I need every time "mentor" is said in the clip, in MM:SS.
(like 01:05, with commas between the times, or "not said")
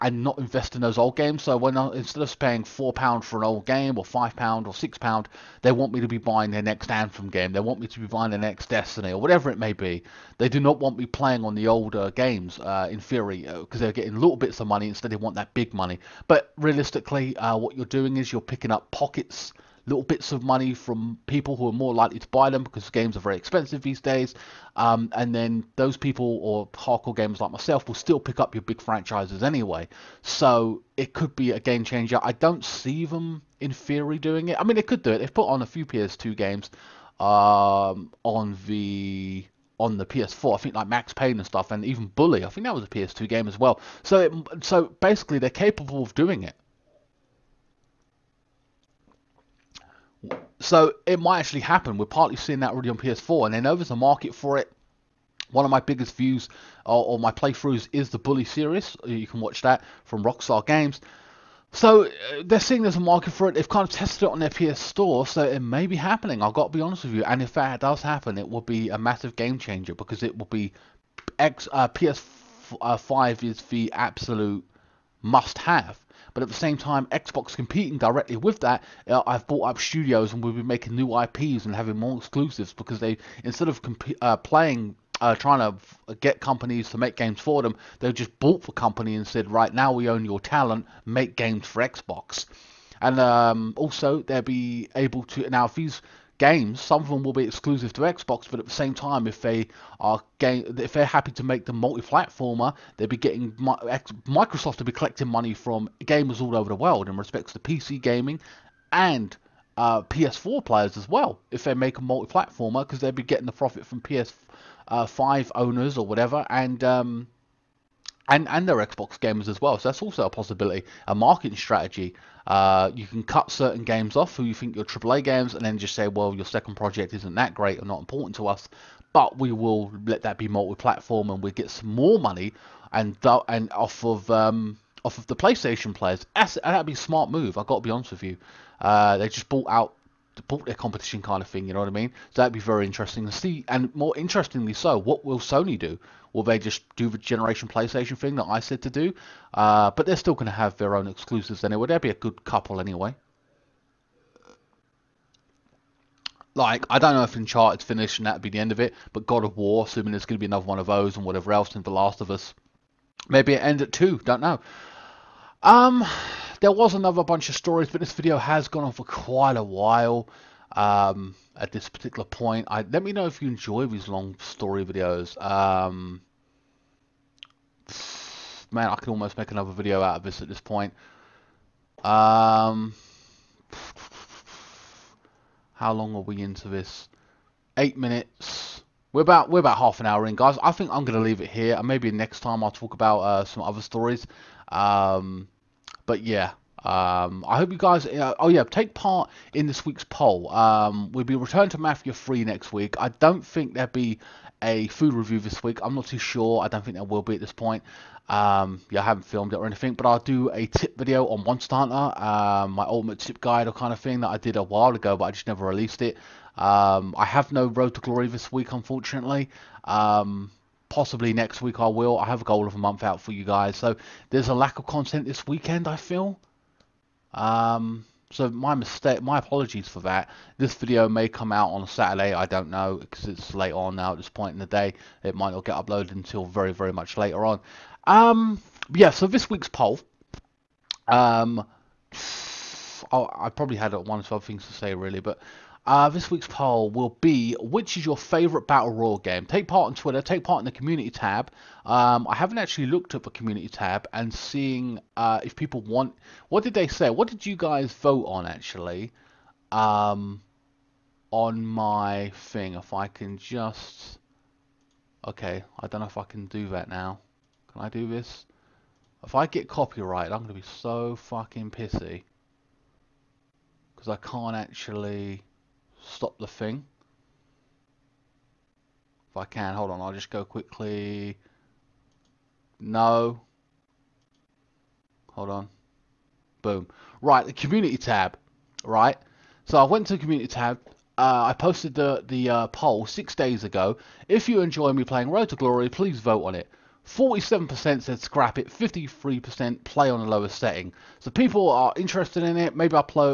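not said.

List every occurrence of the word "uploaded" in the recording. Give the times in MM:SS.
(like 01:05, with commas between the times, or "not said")
03:55.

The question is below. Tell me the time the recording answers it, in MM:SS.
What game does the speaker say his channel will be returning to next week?
03:21.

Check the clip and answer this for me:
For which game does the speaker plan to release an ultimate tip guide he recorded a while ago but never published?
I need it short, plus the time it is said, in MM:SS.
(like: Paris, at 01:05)
Monster Hunter, at 03:31.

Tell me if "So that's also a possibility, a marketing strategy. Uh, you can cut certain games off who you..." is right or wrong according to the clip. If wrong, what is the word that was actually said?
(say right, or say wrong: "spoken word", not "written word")
right.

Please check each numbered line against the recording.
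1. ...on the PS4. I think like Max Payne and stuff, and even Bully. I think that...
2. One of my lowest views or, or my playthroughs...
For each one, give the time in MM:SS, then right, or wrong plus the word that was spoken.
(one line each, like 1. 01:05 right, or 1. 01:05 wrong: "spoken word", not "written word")
1. 00:39 right
2. 00:55 wrong: "biggest", not "lowest".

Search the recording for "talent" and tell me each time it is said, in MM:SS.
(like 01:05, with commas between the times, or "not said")
01:30.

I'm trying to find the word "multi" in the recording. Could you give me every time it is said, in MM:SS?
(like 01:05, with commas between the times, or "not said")
01:41, 01:52, 02:10.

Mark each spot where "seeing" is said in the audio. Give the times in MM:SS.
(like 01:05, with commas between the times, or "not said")
00:52, 01:02, 04:14.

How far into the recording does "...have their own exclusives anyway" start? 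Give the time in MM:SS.
02:30.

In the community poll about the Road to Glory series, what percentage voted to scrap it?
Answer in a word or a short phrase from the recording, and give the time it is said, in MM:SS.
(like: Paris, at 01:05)
47%, at 04:57.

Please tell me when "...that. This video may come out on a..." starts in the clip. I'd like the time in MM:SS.
03:50.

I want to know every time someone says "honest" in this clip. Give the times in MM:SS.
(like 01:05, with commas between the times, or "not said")
01:06, 02:17.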